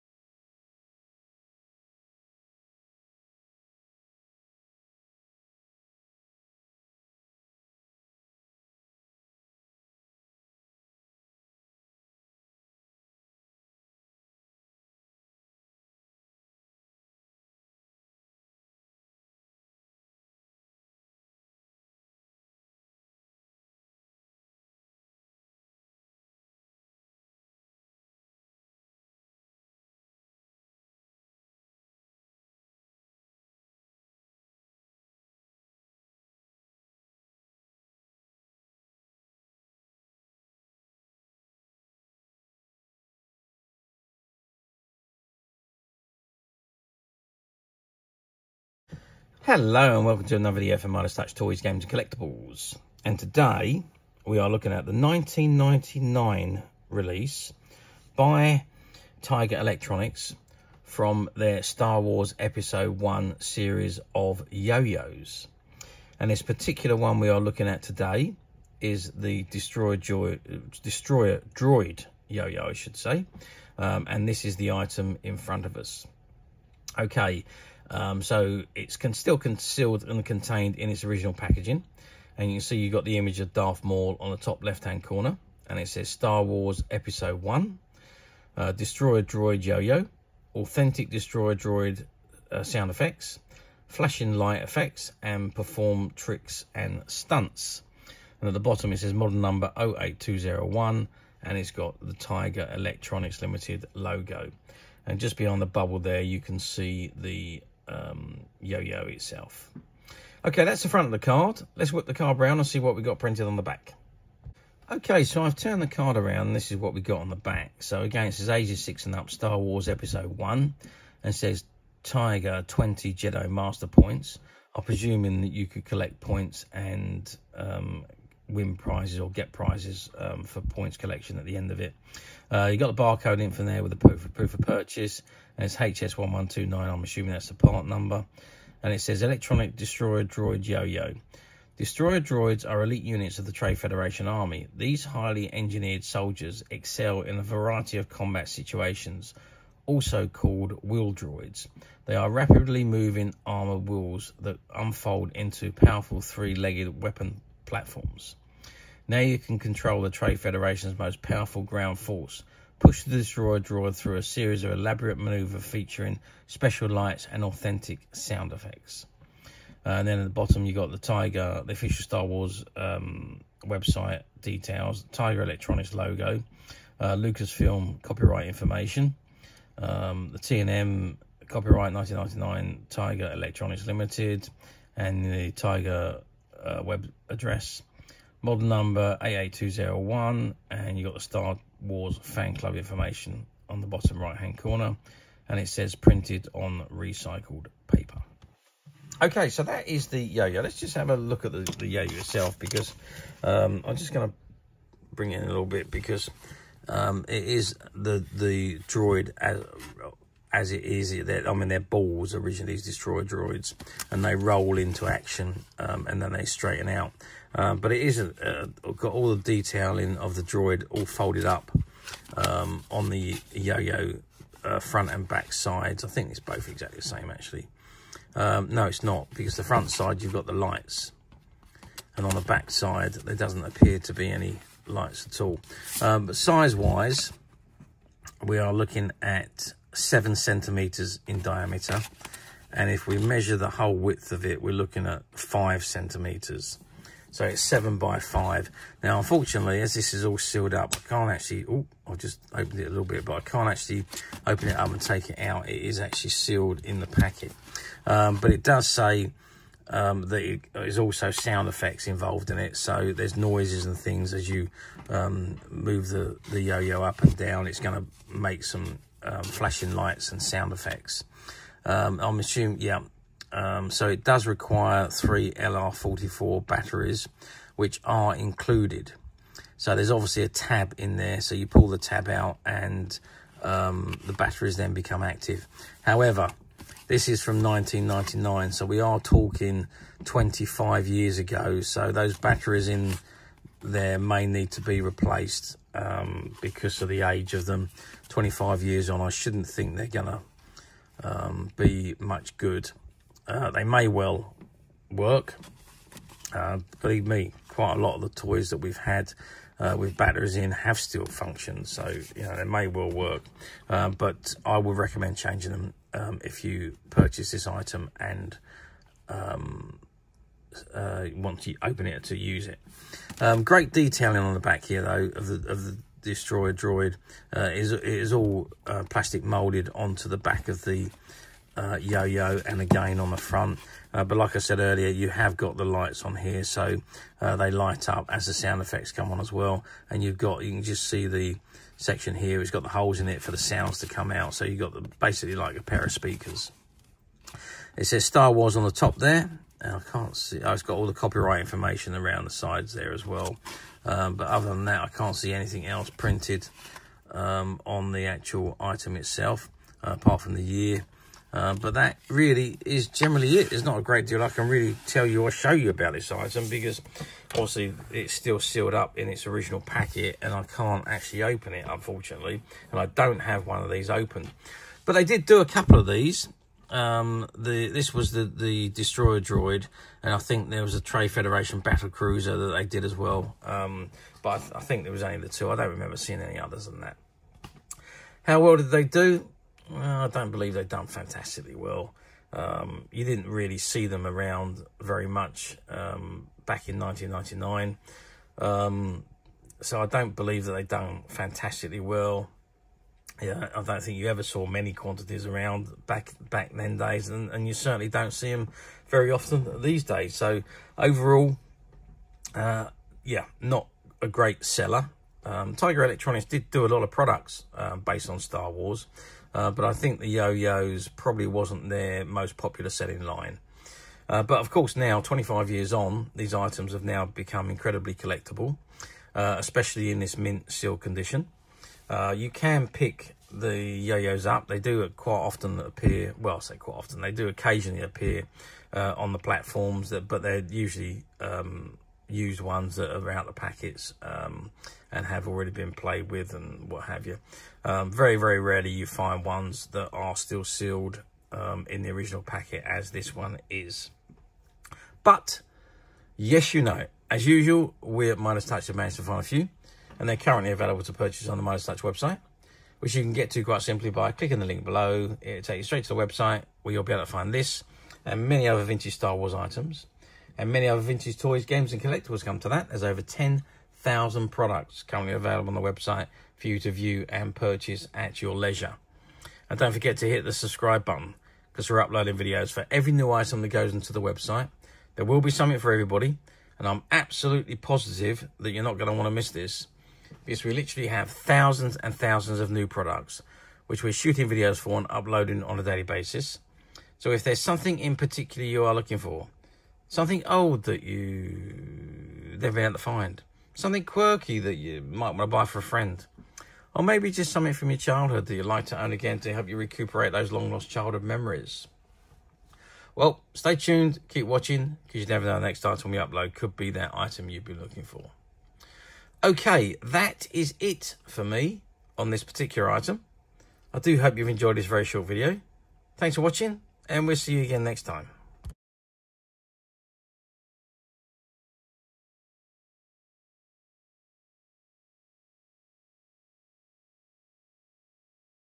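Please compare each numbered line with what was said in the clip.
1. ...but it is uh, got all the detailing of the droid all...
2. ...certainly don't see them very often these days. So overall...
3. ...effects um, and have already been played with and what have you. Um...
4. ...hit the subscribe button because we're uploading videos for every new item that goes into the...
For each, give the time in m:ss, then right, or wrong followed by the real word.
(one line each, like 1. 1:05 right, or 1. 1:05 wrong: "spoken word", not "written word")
1. 3:37 right
2. 6:47 right
3. 7:23 wrong: "packets", not "effects"
4. 8:00 right.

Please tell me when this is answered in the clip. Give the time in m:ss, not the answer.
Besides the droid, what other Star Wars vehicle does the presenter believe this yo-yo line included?
6:20.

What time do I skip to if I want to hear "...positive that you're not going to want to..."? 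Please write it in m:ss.
8:07.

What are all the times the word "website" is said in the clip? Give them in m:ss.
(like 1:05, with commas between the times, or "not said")
2:53, 7:42, 7:46, 7:55, 8:04.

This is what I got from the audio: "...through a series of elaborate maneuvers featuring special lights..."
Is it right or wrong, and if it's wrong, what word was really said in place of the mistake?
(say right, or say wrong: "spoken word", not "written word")
right.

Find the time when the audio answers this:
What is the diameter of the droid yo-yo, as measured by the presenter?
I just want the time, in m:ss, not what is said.
3:59.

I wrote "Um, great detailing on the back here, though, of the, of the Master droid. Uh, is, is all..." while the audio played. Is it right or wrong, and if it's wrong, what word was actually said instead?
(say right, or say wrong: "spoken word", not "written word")
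wrong: "Destroyer", not "Master".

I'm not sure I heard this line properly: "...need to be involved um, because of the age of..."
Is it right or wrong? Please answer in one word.
wrong.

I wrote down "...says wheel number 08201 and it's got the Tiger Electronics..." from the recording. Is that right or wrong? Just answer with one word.
wrong.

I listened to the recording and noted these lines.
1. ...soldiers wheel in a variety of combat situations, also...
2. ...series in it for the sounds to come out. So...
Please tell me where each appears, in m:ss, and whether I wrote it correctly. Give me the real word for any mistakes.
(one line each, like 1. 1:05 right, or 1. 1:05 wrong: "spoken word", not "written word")
1. 2:26 wrong: "excel", not "wheel"
2. 5:42 wrong: "holes", not "series".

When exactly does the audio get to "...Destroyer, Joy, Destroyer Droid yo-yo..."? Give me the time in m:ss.
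1:09.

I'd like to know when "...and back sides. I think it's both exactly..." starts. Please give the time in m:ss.
3:45.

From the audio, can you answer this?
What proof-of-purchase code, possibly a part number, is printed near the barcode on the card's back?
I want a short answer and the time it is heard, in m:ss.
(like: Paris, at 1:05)
HS1129, at 2:15.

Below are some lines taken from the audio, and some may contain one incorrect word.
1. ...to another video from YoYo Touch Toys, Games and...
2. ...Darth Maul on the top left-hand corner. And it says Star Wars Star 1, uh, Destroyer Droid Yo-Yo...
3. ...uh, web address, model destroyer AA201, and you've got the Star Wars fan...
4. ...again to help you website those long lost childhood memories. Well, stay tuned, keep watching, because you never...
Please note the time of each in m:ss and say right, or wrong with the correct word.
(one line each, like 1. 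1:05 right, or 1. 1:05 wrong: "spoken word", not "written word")
1. 0:50 wrong: "Midas", not "YoYo"
2. 1:23 wrong: "Episode", not "Star"
3. 3:06 wrong: "number", not "destroyer"
4. 8:29 wrong: "recuperate", not "website".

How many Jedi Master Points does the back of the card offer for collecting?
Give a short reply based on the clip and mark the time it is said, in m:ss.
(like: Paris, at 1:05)
20, at 2:02.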